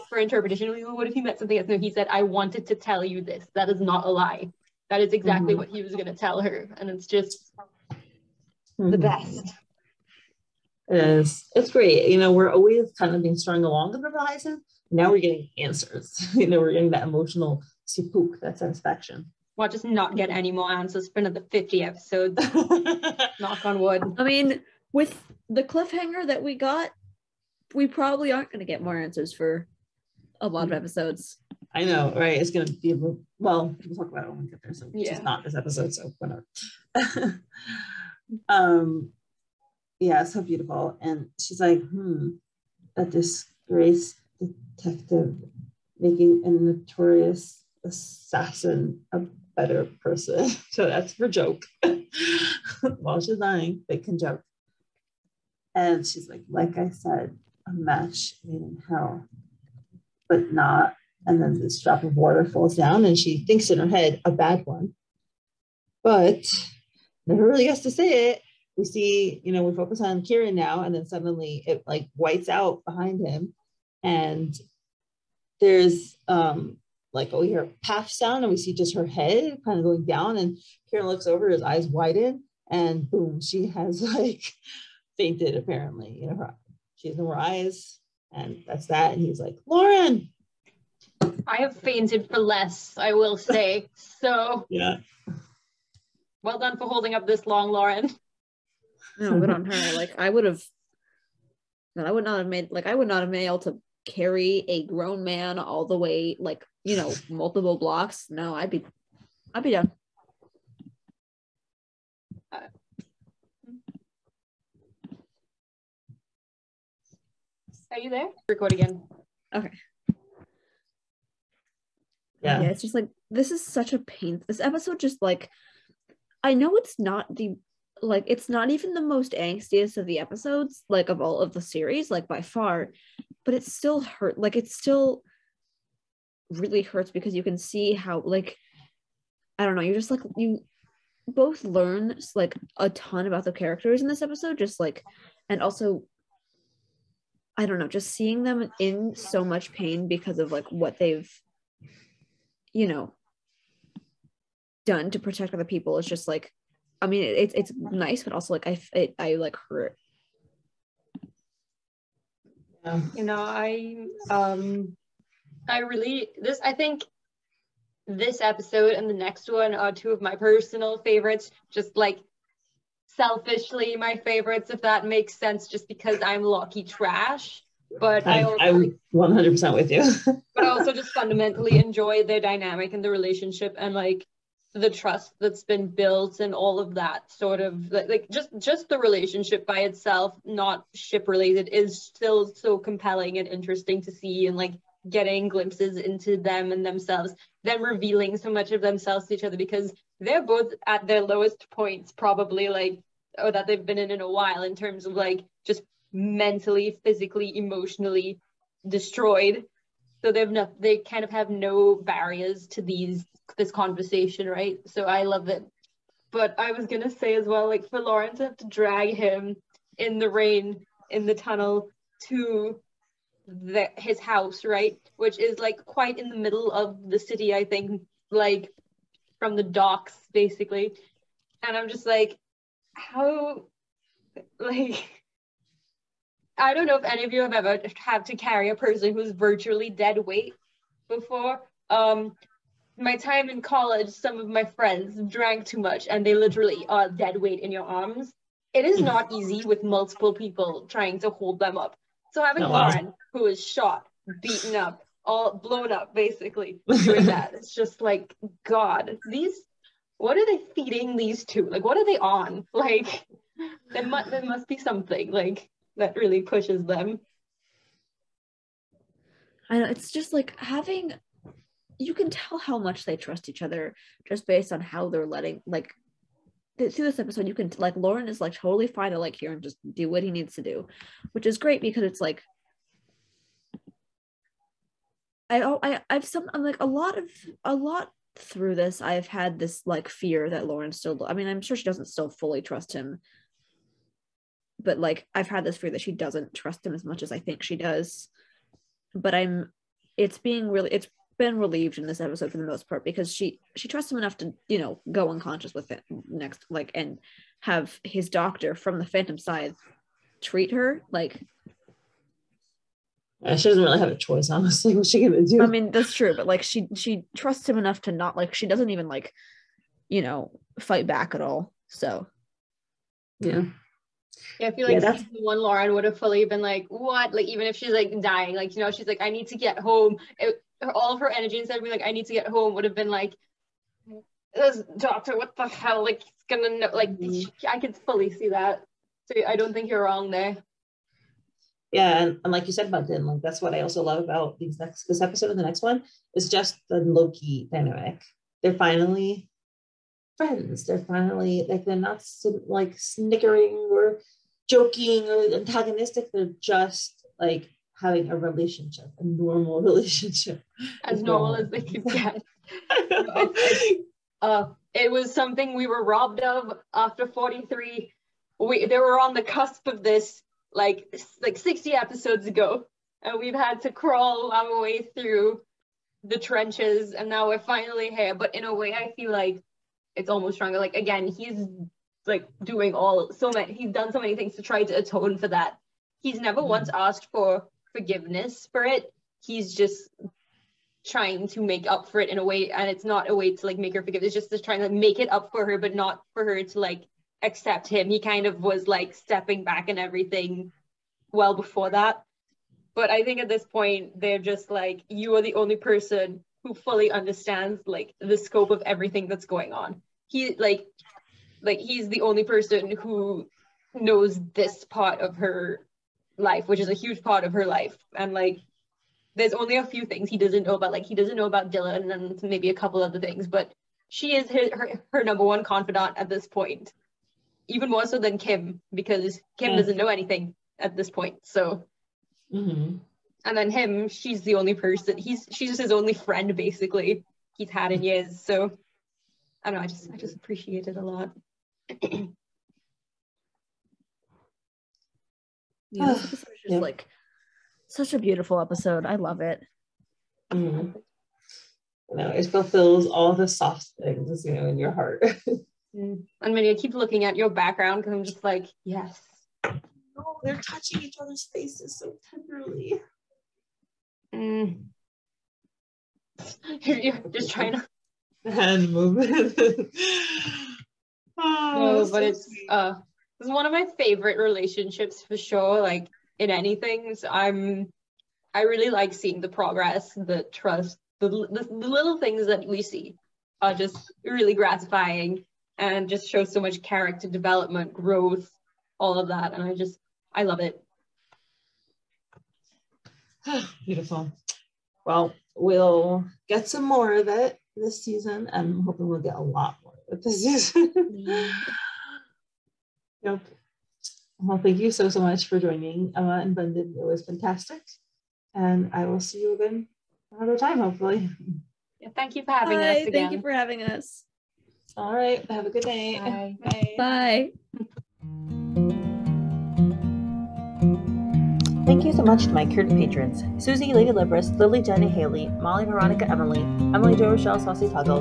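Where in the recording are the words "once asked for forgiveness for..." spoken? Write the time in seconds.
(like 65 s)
386 s.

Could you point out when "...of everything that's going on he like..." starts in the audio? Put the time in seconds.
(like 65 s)
408 s.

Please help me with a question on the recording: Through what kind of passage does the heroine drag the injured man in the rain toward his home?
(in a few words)
the tunnel.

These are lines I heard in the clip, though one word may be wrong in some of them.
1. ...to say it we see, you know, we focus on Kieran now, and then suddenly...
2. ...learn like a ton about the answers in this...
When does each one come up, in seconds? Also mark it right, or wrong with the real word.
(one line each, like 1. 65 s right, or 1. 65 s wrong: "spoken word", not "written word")
1. 67 s right
2. 141 s wrong: "characters", not "answers".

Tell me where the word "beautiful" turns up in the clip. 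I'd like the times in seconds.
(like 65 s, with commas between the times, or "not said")
40 s, 448 s, 493 s.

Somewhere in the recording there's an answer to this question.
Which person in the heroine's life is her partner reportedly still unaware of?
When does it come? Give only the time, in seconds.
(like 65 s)
421 s.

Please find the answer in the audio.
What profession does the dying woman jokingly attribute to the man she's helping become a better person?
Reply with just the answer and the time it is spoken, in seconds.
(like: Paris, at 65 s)
notorious assassin, at 46 s.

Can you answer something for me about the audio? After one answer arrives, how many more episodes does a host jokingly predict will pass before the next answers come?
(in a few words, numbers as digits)
50.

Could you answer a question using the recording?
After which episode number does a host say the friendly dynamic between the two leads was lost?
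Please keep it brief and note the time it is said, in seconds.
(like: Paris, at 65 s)
43, at 367 s.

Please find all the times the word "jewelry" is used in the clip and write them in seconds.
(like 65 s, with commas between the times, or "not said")
not said.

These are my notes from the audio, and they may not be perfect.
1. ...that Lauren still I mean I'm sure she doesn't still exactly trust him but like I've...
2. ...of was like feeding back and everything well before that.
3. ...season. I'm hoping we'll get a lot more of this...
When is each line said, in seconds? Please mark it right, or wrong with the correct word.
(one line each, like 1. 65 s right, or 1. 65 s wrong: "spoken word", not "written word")
1. 290 s wrong: "fully", not "exactly"
2. 398 s wrong: "stepping", not "feeding"
3. 498 s right.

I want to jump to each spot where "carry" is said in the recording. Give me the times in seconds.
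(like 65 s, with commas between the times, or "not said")
104 s, 238 s.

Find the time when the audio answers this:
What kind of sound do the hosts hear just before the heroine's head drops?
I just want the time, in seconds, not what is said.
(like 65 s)
77 s.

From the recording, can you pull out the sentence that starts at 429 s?
doesn't know anything at this point.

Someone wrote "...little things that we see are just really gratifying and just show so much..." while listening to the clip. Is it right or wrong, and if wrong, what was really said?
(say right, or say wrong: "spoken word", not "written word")
right.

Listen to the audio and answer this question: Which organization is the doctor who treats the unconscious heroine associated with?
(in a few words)
the Phantom Scythe.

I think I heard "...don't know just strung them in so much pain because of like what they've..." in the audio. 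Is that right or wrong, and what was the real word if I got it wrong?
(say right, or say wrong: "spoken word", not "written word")
wrong: "seeing", not "strung".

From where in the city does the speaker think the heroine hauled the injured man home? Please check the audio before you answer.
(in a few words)
the docks.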